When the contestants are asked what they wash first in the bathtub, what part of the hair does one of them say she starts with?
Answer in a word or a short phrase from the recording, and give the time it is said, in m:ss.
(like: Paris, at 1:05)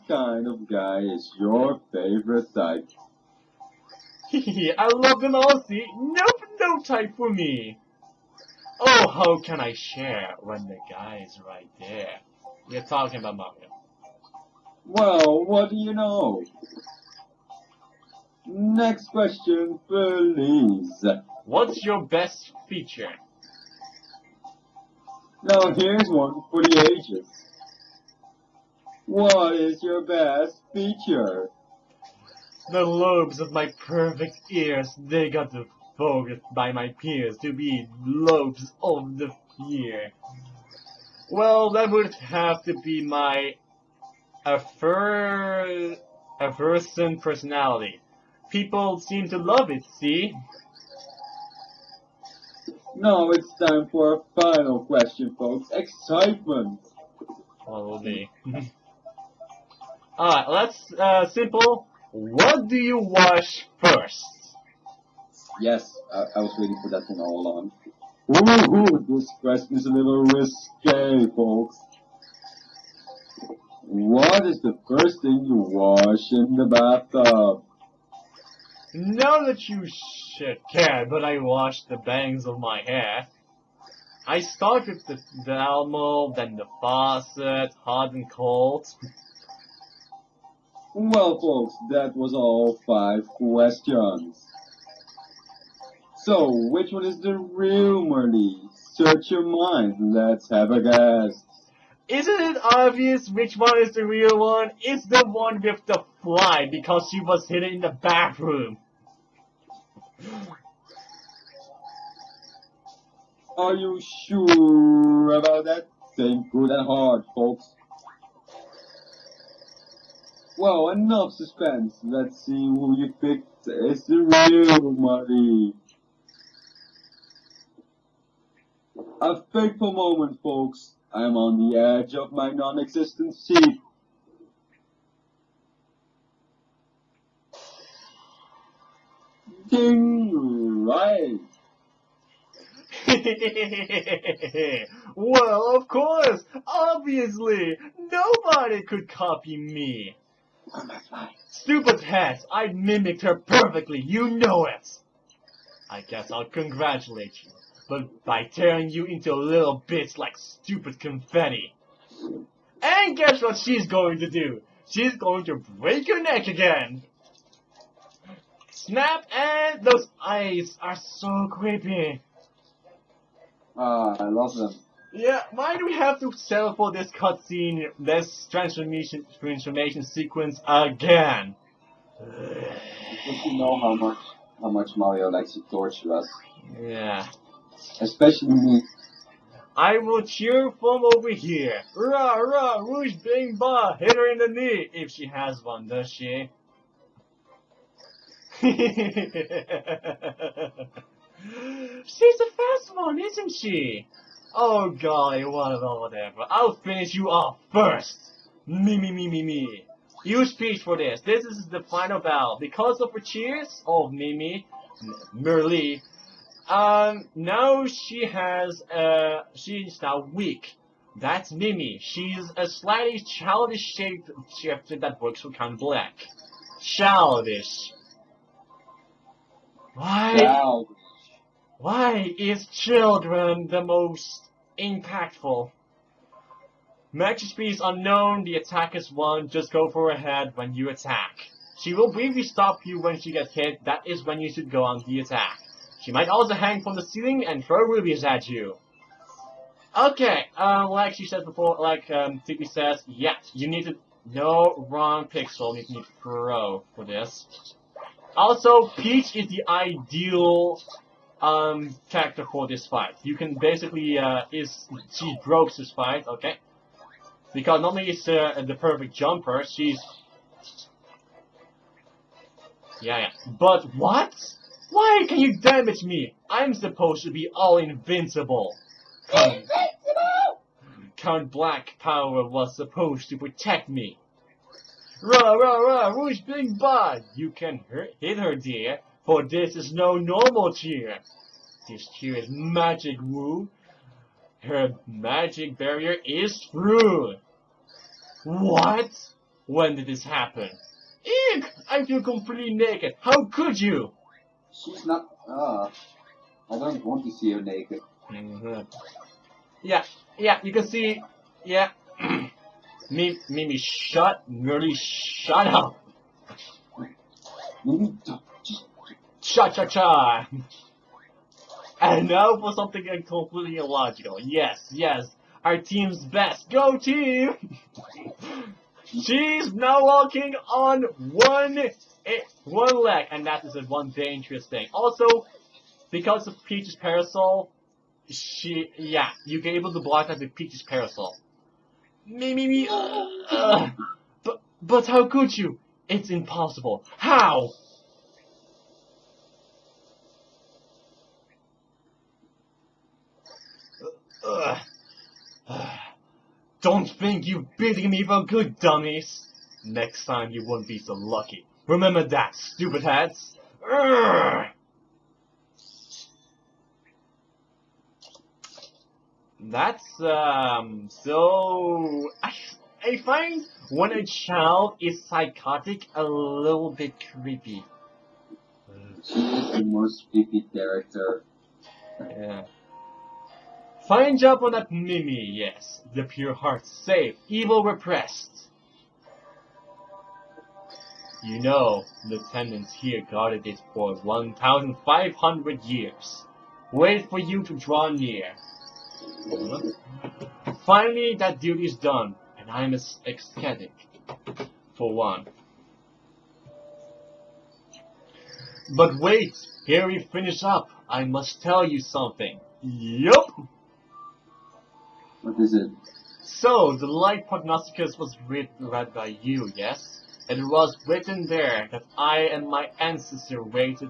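The bangs, at 1:21.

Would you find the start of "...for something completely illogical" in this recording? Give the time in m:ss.
5:22.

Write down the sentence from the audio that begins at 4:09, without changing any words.
Okay, uh, like she said before, like um, says, yeah, you need to...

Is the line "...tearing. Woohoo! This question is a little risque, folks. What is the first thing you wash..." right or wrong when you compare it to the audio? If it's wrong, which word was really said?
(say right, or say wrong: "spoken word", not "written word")
wrong: "along", not "tearing".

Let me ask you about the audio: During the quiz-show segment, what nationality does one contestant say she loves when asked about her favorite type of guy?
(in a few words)
Aussie.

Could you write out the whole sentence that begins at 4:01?
She will briefly stop you when she gets hit, that is when you should go on the attack.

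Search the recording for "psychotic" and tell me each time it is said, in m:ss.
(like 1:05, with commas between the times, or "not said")
6:15.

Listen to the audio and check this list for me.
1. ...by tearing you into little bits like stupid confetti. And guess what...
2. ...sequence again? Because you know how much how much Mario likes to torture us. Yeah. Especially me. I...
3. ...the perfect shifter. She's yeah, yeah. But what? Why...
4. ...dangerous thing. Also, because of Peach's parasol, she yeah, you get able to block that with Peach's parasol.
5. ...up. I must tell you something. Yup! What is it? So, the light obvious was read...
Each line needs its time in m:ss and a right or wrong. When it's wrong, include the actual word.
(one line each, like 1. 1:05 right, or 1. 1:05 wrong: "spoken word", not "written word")
1. 2:38 right
2. 3:00 right
3. 4:28 wrong: "jumper", not "shifter"
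4. 5:34 right
5. 6:50 wrong: "prognosticus", not "obvious".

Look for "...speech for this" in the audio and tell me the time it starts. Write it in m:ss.
3:30.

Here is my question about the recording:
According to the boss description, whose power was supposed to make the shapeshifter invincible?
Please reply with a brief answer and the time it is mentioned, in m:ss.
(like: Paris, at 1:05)
Count Bleck, at 4:41.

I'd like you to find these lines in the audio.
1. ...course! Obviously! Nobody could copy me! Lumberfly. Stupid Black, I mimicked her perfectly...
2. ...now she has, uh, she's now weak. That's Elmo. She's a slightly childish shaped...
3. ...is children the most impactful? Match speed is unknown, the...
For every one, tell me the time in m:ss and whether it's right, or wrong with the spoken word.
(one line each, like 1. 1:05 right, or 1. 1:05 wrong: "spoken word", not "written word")
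1. 2:25 wrong: "Hess", not "Black"
2. 3:37 wrong: "Mimi", not "Elmo"
3. 3:52 right.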